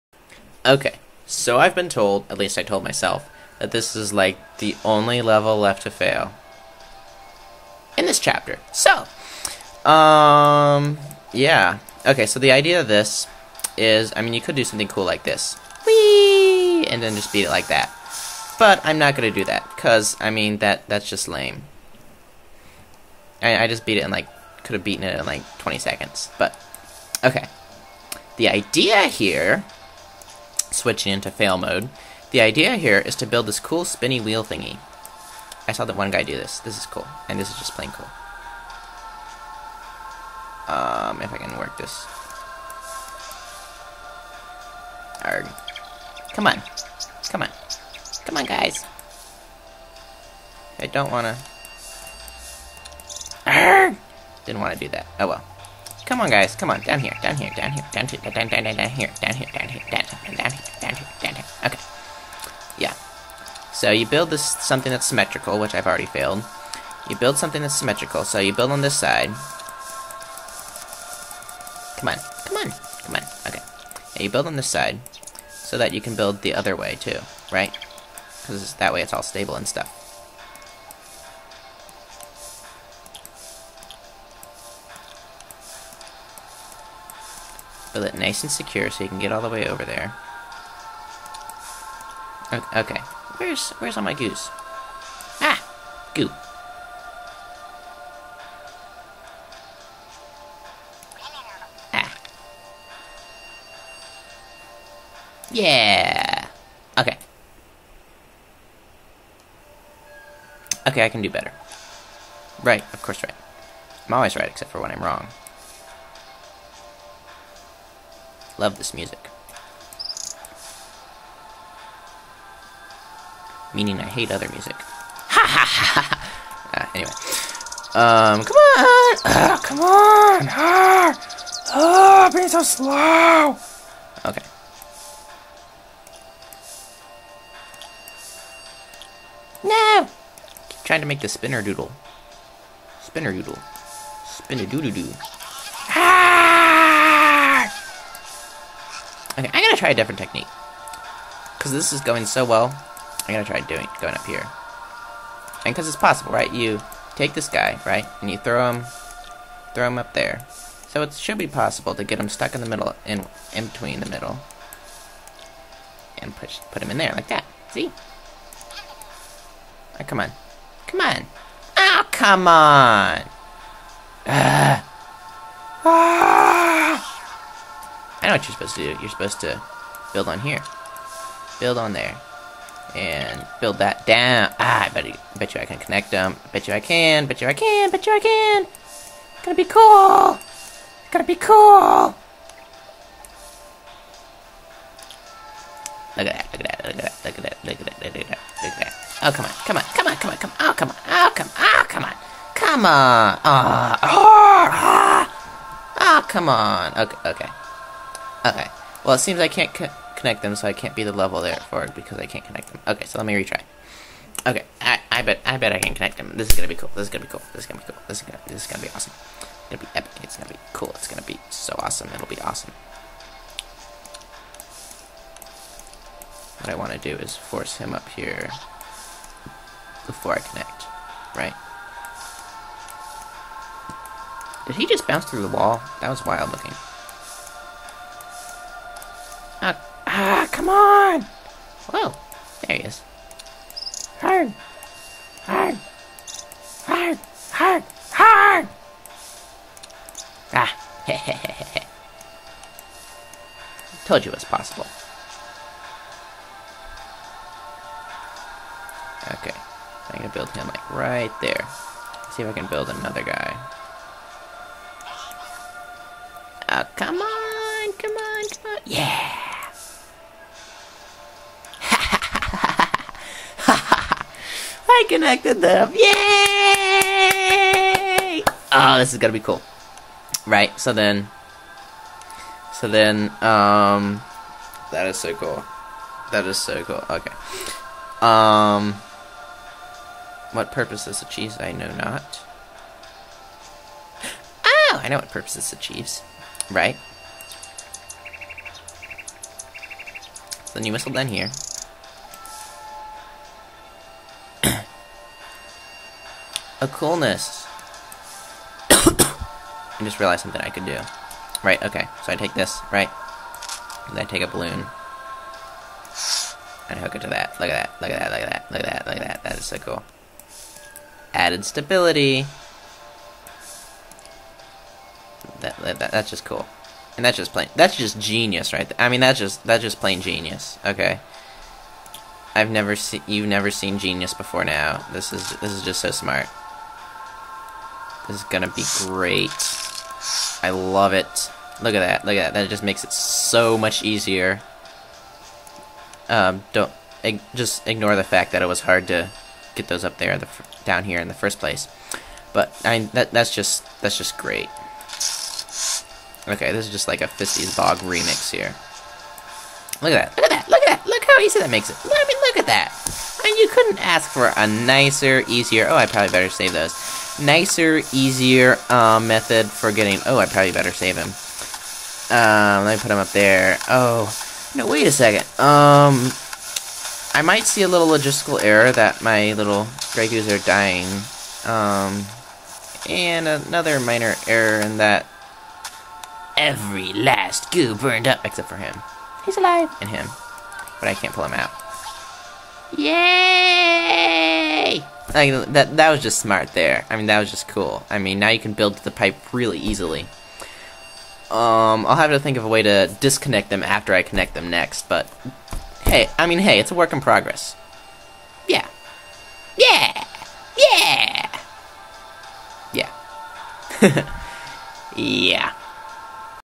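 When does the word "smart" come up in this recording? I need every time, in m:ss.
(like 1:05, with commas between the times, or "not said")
5:36, 6:36.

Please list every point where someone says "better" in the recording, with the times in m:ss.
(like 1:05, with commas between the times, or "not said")
1:51, 6:06, 6:10.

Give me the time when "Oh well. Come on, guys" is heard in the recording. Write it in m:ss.
0:55.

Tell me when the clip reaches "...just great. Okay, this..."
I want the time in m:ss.
5:54.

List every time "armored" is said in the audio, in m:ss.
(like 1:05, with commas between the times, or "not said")
not said.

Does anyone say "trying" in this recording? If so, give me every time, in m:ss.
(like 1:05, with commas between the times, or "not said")
2:20.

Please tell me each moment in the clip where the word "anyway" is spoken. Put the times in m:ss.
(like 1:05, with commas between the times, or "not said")
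2:06.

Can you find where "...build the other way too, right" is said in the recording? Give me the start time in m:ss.
1:16.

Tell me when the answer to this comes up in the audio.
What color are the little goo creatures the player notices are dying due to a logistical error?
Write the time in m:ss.
6:20.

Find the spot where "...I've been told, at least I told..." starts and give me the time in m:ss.
0:01.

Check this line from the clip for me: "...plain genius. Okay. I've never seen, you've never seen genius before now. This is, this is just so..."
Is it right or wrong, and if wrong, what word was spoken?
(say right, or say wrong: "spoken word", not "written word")
right.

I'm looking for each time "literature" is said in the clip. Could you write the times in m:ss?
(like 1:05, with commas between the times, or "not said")
not said.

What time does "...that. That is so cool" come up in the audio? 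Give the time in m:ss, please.
5:19.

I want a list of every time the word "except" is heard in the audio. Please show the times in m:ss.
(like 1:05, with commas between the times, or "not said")
1:54, 6:28.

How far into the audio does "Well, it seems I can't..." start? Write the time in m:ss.
3:29.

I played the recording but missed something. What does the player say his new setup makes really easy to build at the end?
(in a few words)
the pipe.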